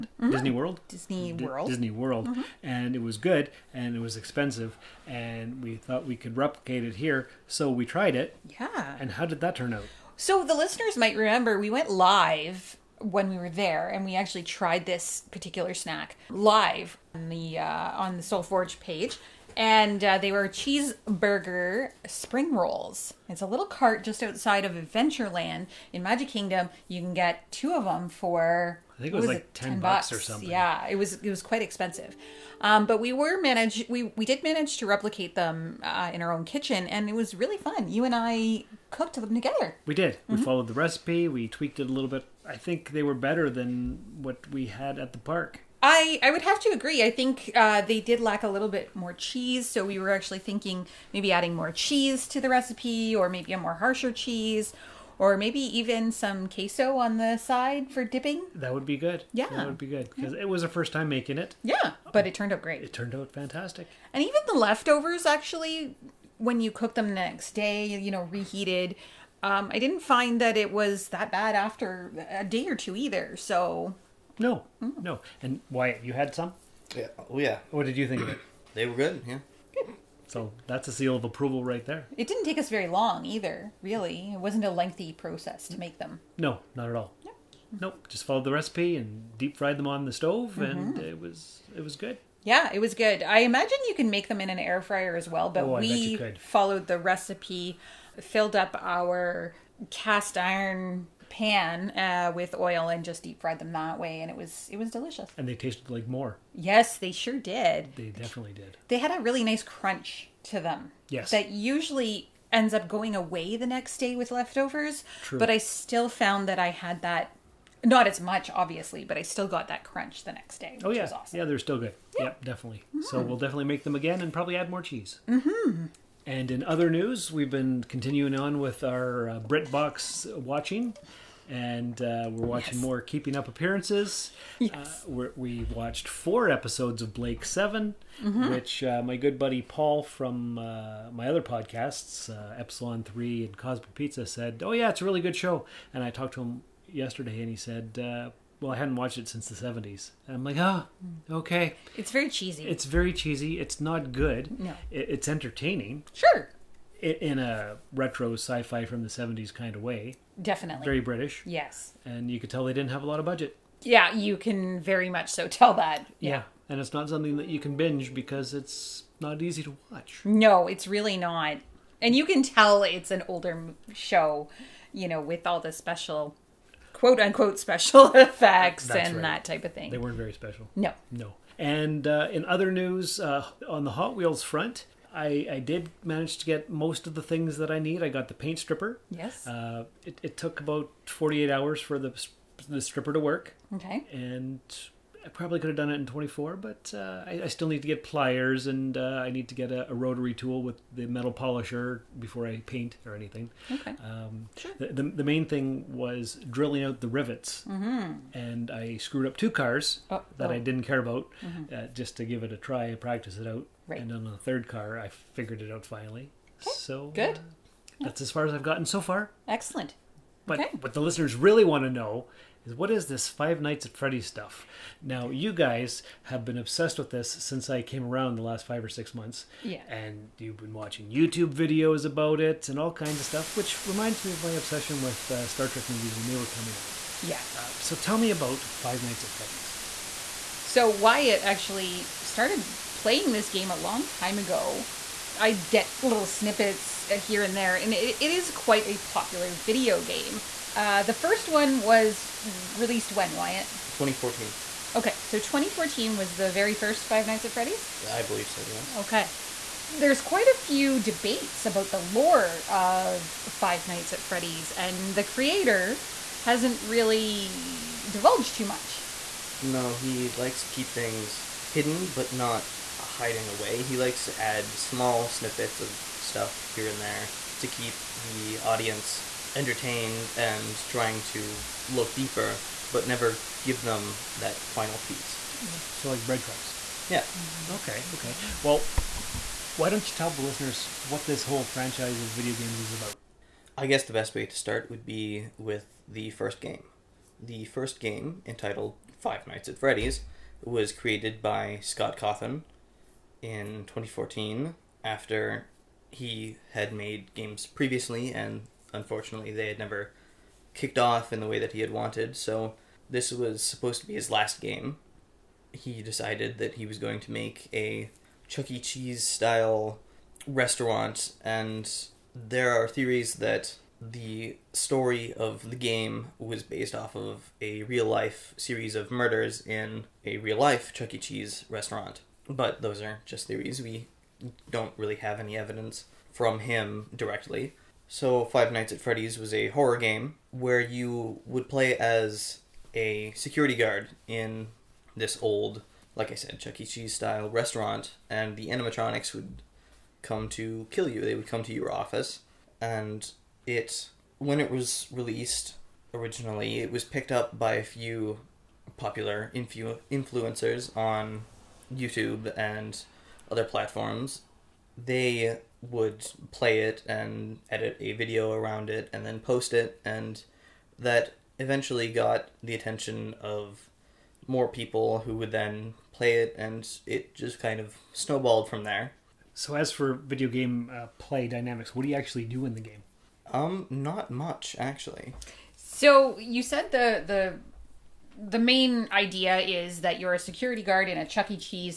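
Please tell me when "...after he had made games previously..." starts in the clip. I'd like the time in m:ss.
5:05.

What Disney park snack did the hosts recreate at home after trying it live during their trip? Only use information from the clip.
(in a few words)
Cheeseburger spring rolls.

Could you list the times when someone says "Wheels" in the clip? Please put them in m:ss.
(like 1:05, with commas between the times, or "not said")
3:04.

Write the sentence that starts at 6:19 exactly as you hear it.
So, as for video game uh, play dynamics, what do you actually do in the game?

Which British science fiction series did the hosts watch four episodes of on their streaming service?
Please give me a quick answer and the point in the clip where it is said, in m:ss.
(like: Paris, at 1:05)
Blake 7, at 2:17.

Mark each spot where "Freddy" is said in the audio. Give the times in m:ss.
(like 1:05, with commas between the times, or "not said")
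3:43, 3:59, 4:17, 4:24, 4:59, 5:39.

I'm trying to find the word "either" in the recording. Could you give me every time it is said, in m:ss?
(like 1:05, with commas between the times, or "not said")
1:12, 1:23.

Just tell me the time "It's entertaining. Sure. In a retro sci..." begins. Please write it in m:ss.
2:34.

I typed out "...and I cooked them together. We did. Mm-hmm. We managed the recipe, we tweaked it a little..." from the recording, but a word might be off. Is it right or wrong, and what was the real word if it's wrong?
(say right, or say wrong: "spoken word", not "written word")
wrong: "followed", not "managed".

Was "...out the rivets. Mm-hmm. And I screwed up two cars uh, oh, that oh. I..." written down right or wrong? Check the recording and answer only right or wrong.
right.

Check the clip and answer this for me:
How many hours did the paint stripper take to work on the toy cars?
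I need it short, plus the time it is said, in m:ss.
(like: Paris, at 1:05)
48, at 3:11.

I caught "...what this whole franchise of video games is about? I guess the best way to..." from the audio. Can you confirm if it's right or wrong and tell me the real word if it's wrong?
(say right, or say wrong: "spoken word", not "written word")
right.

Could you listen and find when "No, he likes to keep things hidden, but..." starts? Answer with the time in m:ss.
4:29.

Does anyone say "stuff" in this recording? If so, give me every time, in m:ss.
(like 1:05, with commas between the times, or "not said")
3:44, 3:53, 4:36.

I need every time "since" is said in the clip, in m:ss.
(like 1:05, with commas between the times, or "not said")
2:29, 3:47.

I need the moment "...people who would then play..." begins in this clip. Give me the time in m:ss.
6:14.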